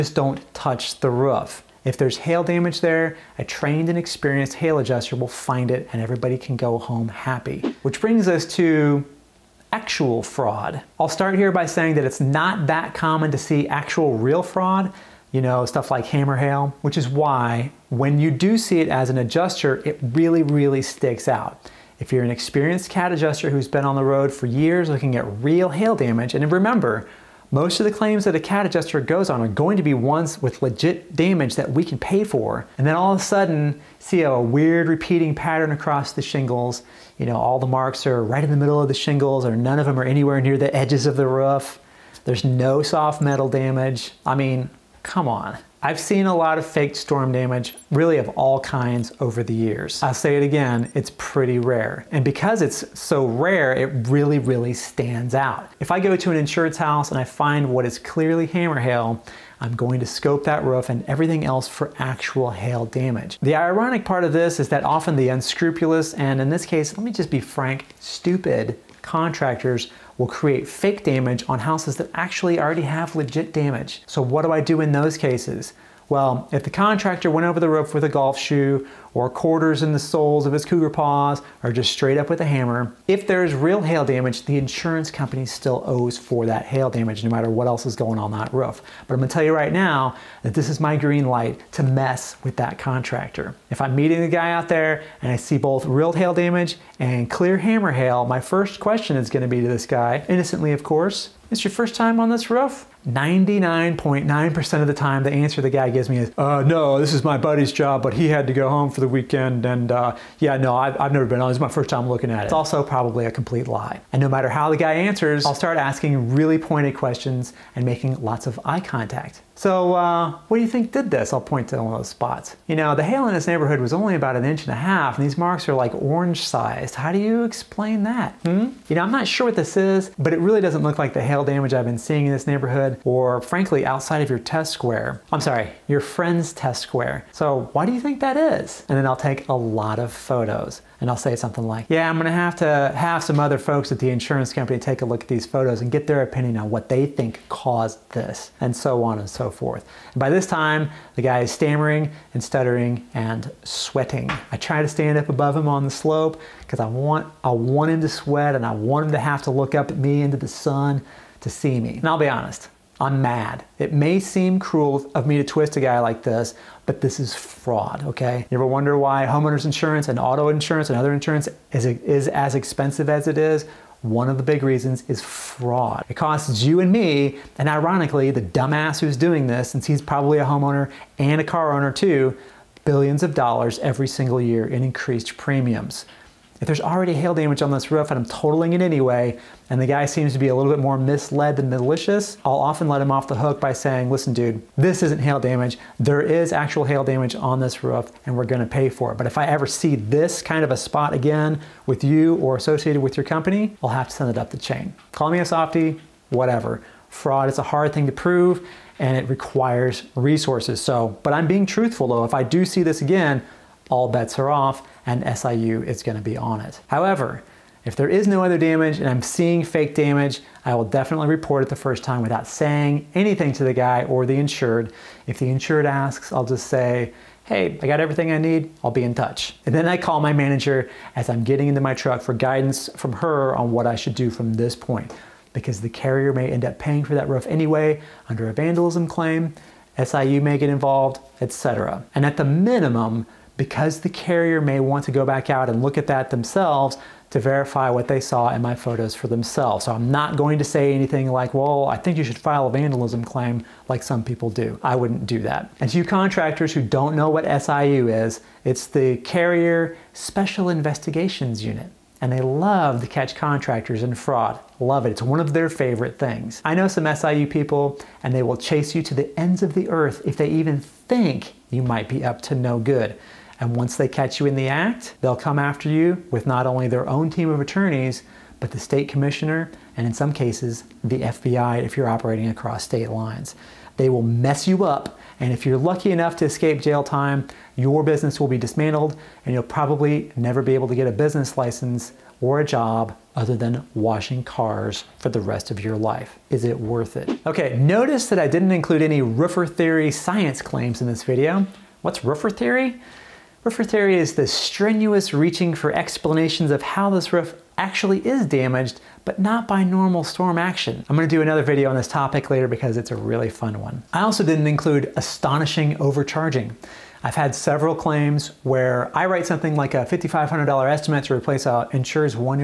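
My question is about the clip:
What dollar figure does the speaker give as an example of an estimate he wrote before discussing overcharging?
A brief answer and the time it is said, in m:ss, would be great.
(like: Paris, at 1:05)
$5,500, at 5:20.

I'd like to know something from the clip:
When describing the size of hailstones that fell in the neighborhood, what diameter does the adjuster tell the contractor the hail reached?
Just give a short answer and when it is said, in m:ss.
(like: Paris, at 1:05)
1.5 inches, at 2:04.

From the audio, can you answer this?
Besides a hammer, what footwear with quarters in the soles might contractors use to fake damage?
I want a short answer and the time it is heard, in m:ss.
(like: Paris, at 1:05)
Cougar paws, at 1:20.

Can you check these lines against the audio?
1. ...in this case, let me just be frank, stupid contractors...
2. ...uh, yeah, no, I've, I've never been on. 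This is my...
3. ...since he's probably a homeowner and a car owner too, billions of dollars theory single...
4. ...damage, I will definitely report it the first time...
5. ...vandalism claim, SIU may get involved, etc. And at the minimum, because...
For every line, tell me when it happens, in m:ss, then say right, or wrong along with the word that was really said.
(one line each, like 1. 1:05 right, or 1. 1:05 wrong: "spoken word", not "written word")
1. 1:06 right
2. 1:49 right
3. 2:59 wrong: "every", not "theory"
4. 3:39 right
5. 3:58 right.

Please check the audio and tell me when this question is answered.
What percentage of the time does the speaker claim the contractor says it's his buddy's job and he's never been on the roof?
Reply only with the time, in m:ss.
1:43.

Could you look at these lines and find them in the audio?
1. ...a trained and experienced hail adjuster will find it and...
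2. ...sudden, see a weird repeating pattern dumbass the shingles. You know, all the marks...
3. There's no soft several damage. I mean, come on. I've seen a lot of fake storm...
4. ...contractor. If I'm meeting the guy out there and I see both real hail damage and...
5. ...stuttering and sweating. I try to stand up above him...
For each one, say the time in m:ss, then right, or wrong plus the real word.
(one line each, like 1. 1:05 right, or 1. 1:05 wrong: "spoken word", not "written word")
1. 0:03 right
2. 0:33 wrong: "across", not "dumbass"
3. 0:42 wrong: "metal", not "several"
4. 1:32 right
5. 2:32 right.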